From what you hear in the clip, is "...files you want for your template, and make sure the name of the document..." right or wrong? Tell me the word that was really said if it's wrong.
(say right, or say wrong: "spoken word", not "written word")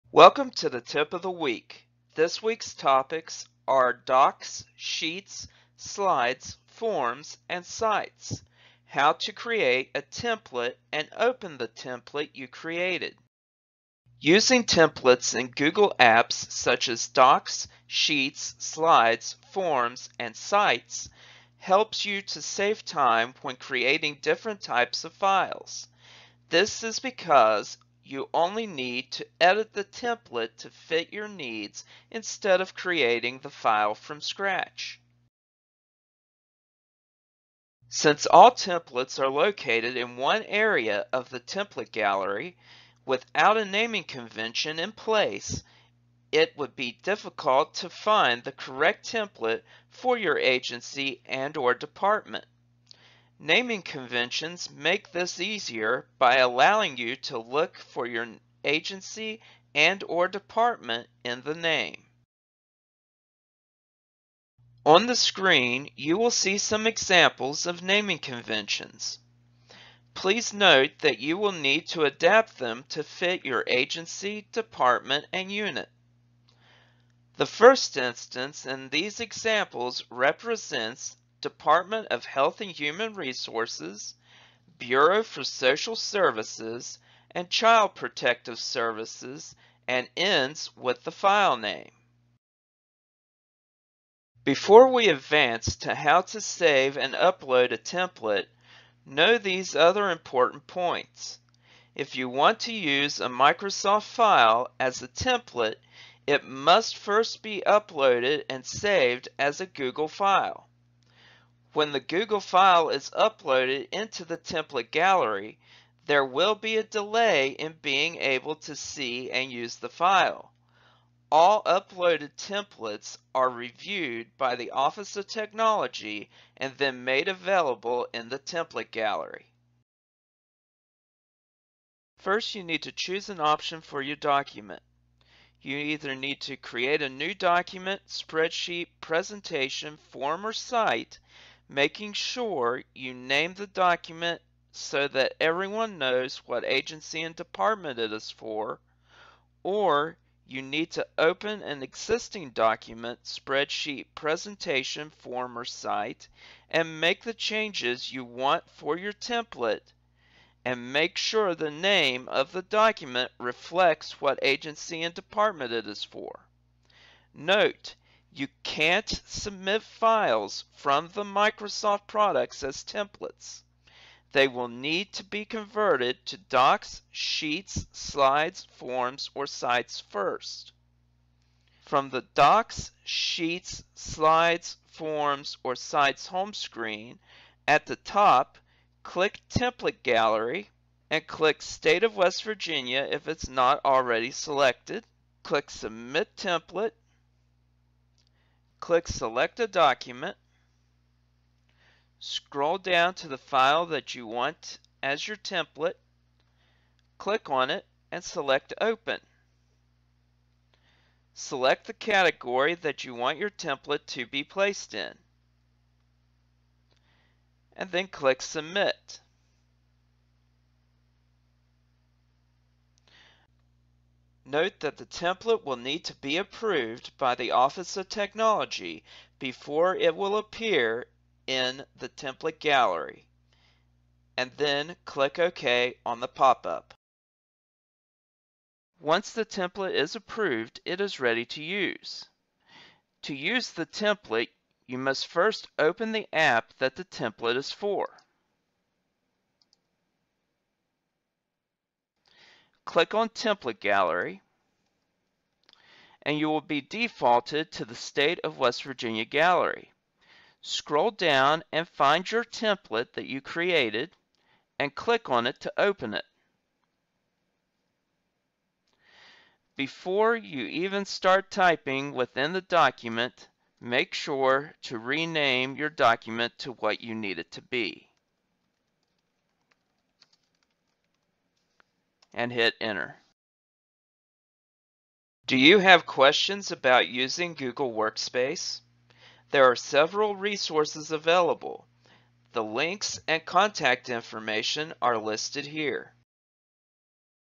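wrong: "changes", not "files".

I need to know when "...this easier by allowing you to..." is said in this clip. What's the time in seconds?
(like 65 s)
55 s.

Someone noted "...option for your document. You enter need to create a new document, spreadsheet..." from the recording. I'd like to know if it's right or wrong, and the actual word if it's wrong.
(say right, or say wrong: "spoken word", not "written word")
wrong: "either", not "enter".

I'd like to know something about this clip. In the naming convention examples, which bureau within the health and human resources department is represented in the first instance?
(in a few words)
Bureau for Social Services.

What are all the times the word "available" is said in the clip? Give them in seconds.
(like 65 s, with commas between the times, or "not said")
127 s, 291 s.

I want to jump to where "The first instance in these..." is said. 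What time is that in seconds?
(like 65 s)
77 s.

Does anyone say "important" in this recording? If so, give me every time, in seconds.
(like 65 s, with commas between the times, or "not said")
100 s.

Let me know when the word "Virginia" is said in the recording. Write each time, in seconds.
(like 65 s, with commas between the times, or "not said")
192 s, 258 s.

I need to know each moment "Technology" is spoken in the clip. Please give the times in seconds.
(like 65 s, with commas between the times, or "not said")
125 s, 228 s.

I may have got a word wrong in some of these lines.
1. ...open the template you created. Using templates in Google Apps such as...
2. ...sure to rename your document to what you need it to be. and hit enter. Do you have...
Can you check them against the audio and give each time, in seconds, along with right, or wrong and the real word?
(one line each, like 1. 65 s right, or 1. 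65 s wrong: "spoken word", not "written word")
1. 11 s right
2. 274 s right.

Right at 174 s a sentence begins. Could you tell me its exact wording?
They will need to be converted to docs, sheets, slides, forms, or sites first.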